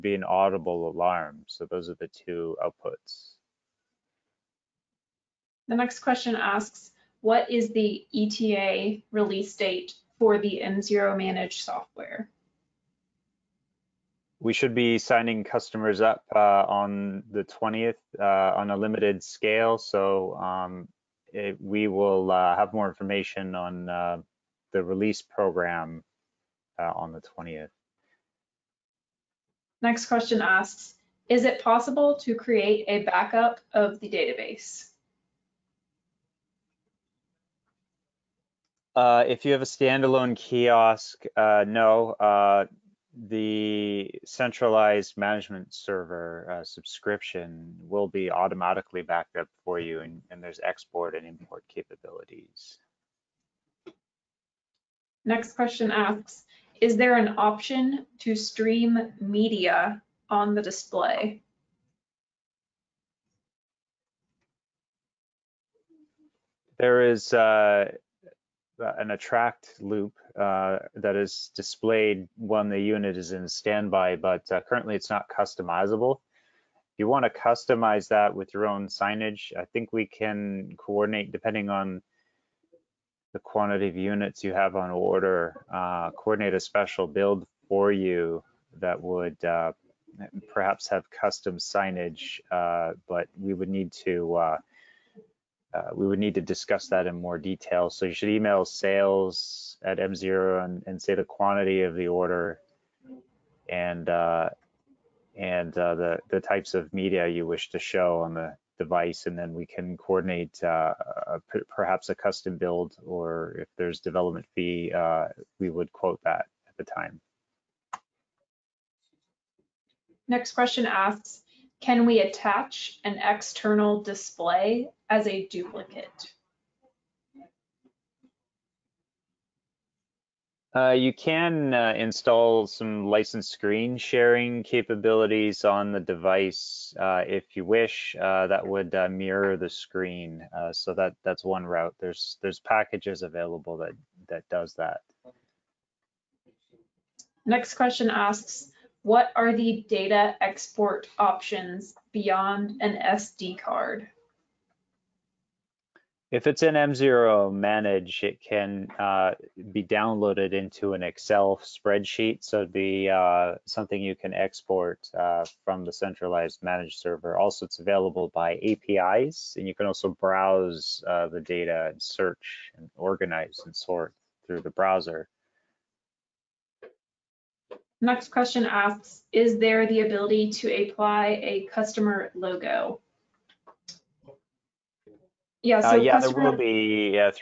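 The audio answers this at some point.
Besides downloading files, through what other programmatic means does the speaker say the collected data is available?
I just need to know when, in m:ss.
2:48.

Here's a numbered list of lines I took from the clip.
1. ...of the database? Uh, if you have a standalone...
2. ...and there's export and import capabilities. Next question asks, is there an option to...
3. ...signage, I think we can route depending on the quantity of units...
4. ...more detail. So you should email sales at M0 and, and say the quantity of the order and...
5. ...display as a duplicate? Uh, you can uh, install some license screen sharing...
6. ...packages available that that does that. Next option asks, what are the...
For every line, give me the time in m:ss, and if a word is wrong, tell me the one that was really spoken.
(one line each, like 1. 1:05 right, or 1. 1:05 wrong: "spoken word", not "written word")
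1. 0:33 right
2. 0:50 right
3. 1:18 wrong: "coordinate", not "route"
4. 1:37 right
5. 2:04 right
6. 2:22 wrong: "question", not "option".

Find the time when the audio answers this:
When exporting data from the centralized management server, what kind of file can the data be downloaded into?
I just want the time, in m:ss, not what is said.
2:41.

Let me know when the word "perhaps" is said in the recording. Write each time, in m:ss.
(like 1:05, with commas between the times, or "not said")
1:30, 1:51.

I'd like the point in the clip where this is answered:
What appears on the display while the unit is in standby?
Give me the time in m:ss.
1:08.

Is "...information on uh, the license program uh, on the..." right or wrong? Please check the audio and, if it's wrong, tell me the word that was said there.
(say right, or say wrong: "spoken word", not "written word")
wrong: "release", not "license".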